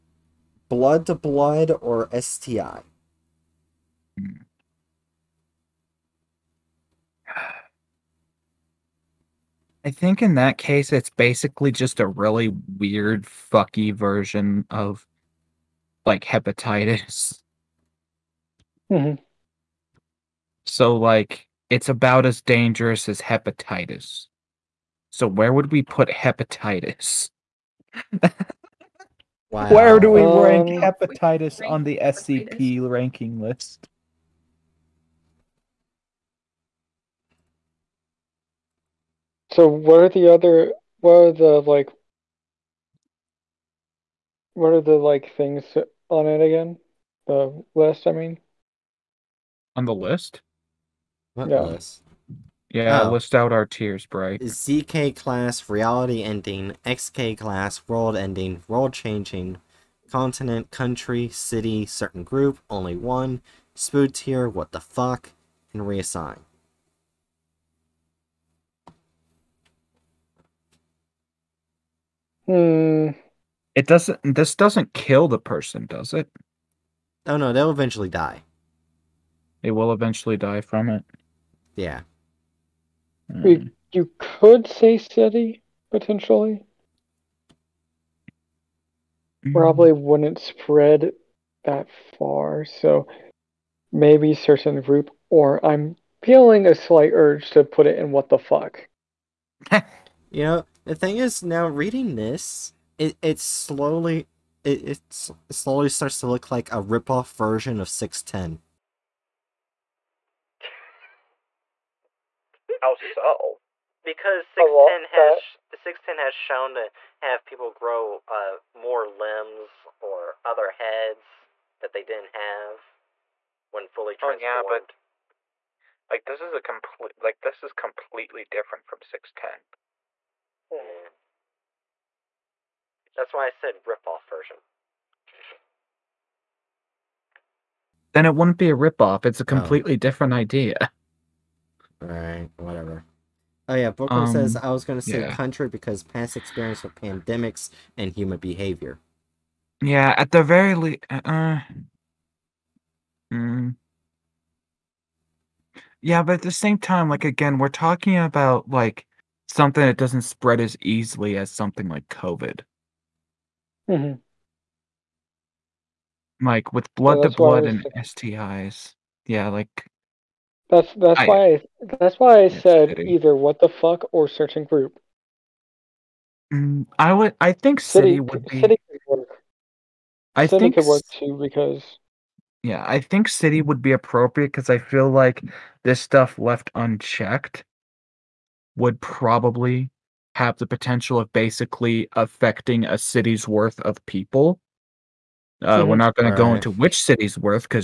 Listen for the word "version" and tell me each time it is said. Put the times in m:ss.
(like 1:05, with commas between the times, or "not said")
0:13, 1:47, 2:14.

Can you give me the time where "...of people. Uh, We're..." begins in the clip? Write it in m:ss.
3:13.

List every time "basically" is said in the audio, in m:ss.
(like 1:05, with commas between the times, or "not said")
0:11, 3:11.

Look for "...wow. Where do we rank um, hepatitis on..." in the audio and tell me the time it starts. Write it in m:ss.
0:29.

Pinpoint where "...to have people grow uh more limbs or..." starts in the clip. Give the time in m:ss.
1:56.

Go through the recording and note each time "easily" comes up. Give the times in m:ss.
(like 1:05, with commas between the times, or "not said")
2:40.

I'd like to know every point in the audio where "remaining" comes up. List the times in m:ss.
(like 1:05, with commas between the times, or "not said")
not said.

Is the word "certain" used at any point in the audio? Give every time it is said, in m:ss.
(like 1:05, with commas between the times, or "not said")
1:01, 1:34, 2:54.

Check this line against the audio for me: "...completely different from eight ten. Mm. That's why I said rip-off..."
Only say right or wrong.
wrong.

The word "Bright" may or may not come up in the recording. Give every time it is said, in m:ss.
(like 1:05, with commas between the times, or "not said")
0:54.